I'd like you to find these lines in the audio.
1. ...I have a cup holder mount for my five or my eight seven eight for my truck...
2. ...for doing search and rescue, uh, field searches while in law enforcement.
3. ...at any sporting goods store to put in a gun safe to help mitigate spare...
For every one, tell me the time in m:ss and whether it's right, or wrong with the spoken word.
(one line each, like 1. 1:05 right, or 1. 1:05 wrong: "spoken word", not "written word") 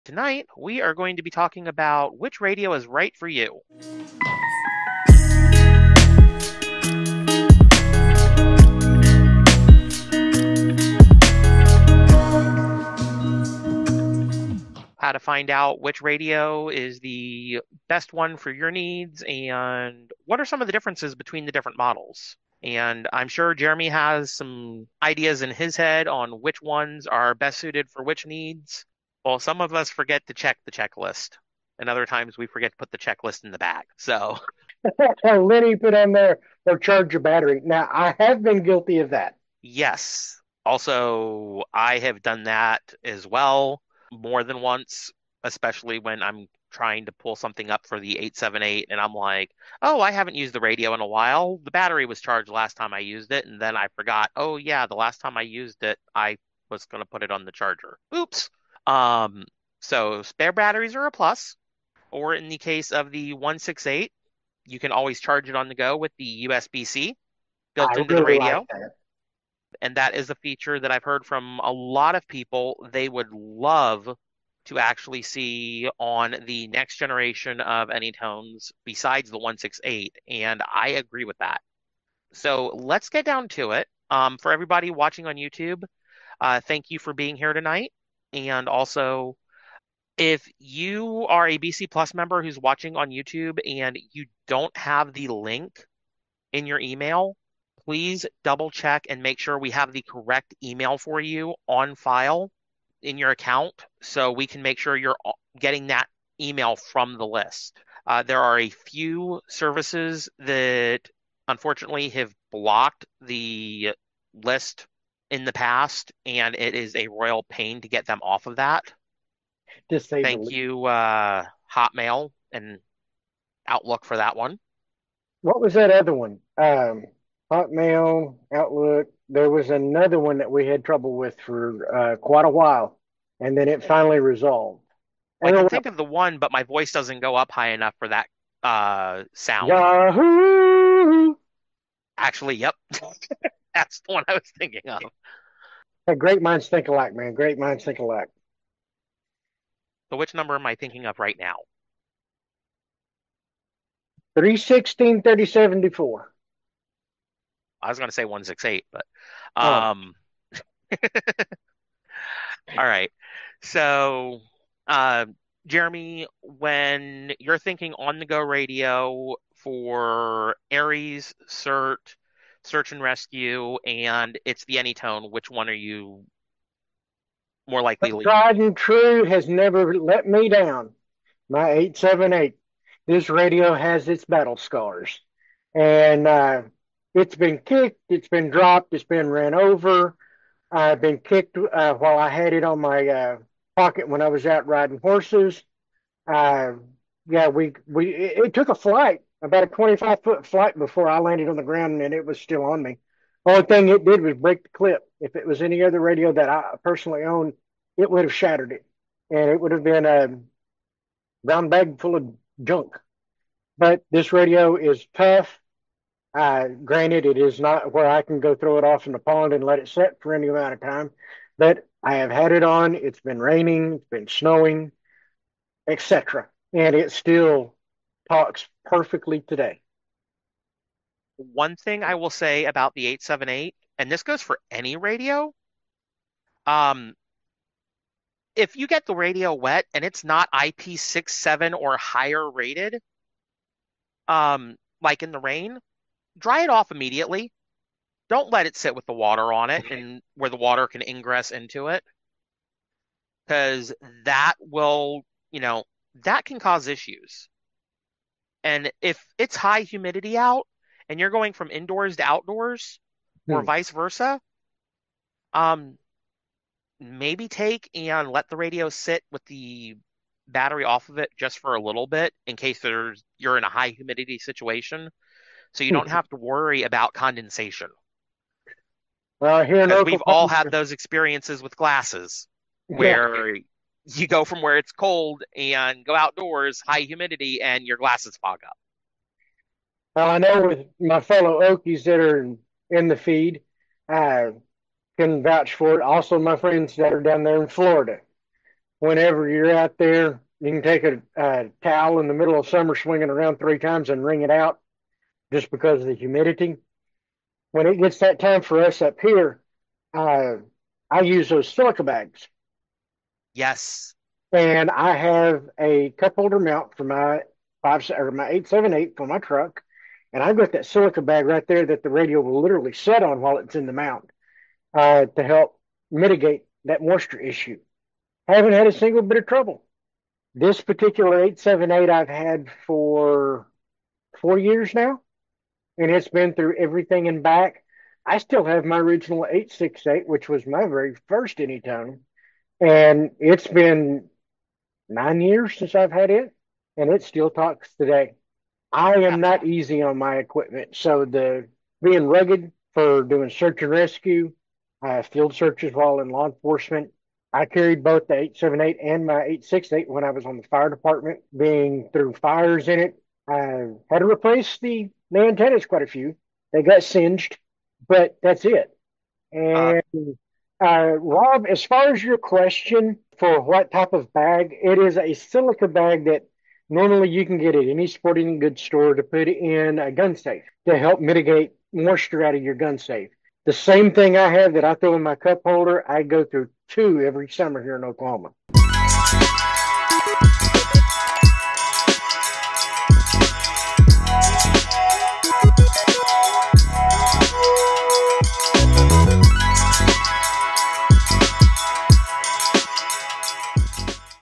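1. 5:14 right
2. 5:52 right
3. 6:17 wrong: "moisture", not "spare".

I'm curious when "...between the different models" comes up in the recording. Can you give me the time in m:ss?
0:21.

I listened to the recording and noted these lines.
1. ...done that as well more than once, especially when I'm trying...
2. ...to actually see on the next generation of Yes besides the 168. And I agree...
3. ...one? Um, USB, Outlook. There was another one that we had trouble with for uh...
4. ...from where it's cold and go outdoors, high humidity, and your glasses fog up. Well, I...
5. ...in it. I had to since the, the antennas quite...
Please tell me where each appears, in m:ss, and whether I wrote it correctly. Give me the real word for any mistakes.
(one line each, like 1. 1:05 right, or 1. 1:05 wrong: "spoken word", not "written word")
1. 0:42 right
2. 1:14 wrong: "Anytones", not "Yes"
3. 2:06 wrong: "Hotmail", not "USB"
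4. 4:44 right
5. 6:02 wrong: "replace", not "since".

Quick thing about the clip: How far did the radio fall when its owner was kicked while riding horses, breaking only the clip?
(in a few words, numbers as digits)
25 foot.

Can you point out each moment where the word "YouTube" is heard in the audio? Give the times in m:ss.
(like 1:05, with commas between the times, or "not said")
1:25, 1:33.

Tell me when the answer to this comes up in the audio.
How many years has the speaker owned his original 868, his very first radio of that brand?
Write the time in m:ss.
5:45.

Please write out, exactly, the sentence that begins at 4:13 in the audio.
Because that will, you know, that can cause issues.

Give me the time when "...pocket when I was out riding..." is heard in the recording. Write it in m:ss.
3:13.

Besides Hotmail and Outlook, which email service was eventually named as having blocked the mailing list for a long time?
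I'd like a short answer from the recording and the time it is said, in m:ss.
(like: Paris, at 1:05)
Yahoo, at 2:19.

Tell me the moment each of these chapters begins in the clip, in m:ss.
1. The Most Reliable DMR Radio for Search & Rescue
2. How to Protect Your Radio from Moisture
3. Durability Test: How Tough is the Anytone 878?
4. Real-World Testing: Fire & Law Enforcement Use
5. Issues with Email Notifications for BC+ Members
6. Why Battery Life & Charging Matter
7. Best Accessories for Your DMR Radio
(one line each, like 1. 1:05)
1. 3:00
2. 4:25
3. 3:39
4. 5:42
5. 1:23
6. 0:46
7. 6:23.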